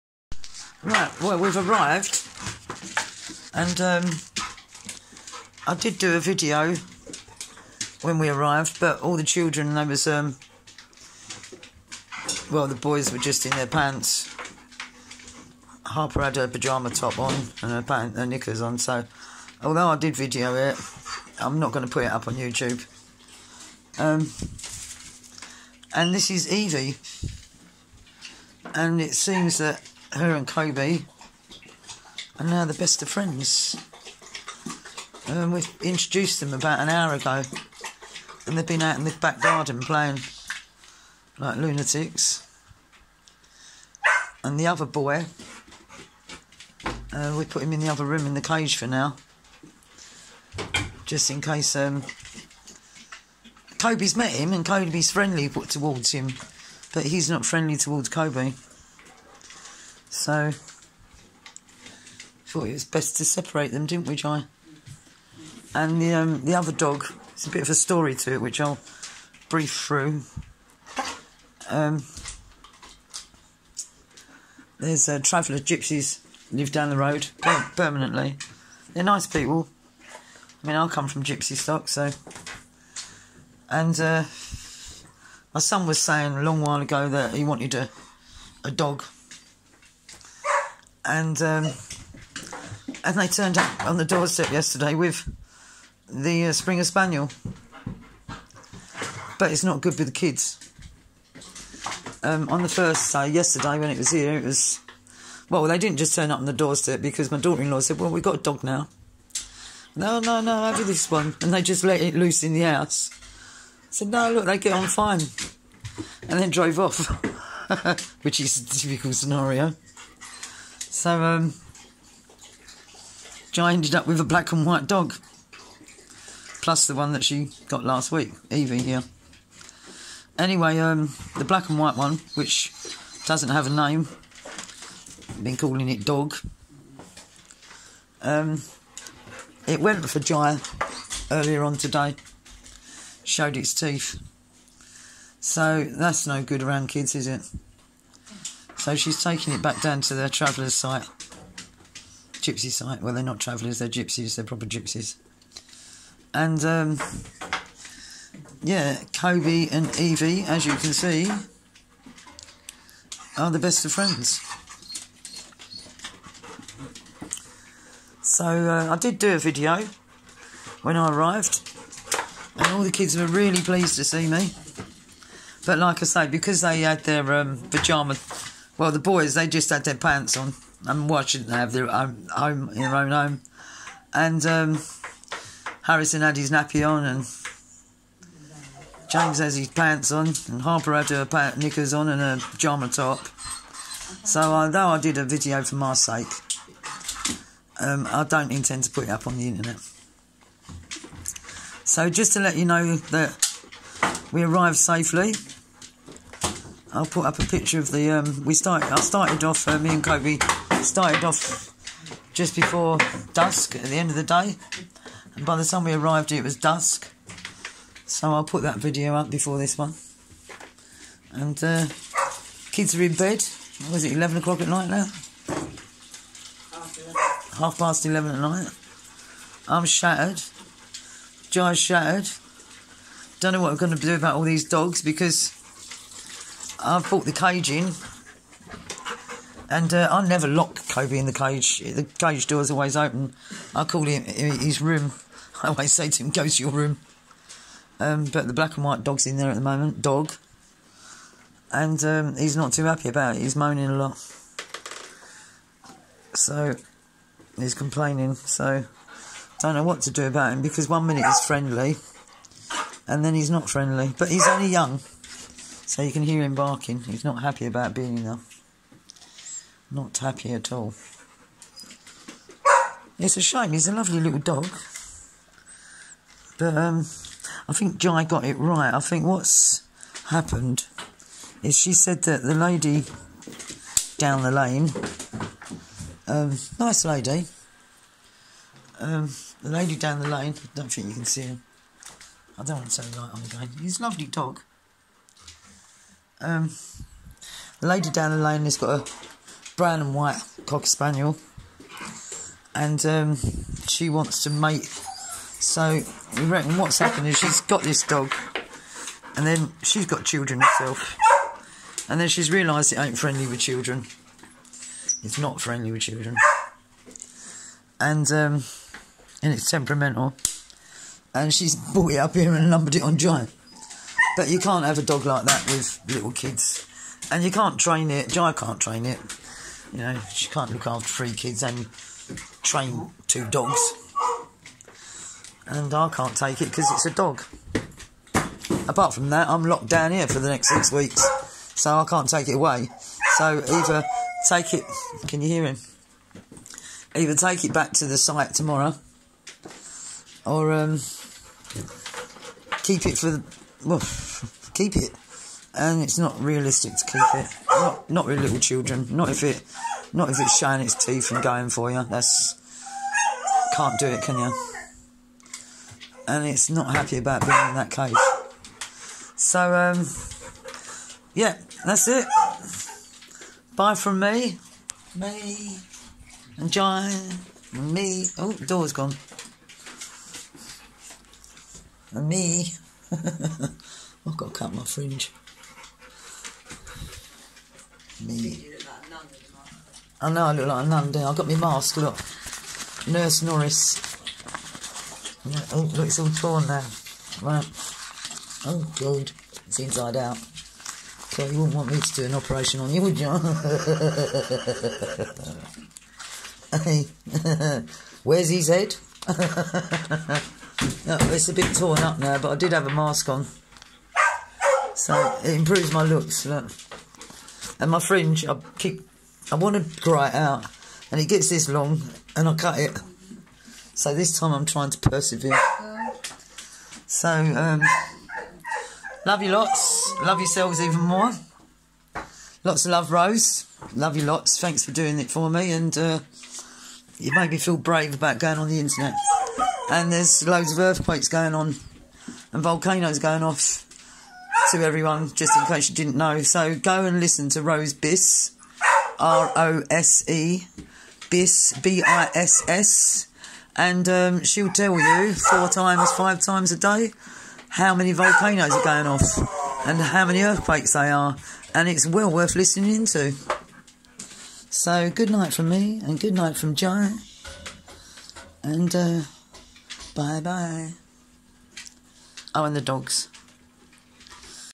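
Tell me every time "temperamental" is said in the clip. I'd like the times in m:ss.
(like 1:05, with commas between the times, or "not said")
5:19.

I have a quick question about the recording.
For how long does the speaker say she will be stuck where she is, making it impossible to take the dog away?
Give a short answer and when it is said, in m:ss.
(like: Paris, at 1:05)
6 weeks, at 5:40.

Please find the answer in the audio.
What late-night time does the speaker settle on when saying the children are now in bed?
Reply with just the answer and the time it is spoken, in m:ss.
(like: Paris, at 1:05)
11:30 pm, at 3:47.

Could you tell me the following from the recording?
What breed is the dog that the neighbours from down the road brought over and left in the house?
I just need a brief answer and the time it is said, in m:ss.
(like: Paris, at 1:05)
Springer Spaniel, at 1:36.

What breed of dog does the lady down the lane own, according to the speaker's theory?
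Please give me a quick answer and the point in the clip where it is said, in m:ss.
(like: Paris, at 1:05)
Cocker spaniel, at 5:00.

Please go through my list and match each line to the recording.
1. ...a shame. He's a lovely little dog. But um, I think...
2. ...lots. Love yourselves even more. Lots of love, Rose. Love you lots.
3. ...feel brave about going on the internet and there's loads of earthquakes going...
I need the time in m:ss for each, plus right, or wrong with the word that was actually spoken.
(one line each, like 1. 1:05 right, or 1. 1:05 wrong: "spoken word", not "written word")
1. 4:33 right
2. 7:09 right
3. 7:17 right.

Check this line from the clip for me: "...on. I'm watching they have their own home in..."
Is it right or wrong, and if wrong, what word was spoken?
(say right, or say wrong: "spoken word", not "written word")
right.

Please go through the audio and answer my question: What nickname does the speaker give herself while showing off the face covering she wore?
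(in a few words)
Nurse Norris.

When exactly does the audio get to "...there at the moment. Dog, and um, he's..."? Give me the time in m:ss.
4:09.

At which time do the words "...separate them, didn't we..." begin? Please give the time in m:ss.
1:03.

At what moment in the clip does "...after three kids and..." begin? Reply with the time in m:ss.
5:30.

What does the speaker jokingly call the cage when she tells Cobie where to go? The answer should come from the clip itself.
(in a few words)
his room.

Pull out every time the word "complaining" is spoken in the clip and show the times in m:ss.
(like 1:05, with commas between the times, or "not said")
4:17.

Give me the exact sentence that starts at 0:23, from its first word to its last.
Um, and this is Evie, and it seems that her and Cobie are now the best of friends.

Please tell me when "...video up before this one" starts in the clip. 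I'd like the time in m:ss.
3:38.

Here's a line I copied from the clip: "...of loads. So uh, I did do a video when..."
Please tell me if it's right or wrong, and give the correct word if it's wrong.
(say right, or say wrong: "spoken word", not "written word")
wrong: "friends", not "loads".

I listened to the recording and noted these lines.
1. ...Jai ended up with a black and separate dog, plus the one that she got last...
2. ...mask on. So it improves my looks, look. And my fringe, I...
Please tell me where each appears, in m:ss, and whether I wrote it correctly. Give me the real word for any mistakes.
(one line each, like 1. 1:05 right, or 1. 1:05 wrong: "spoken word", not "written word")
1. 2:03 wrong: "white", not "separate"
2. 6:52 right.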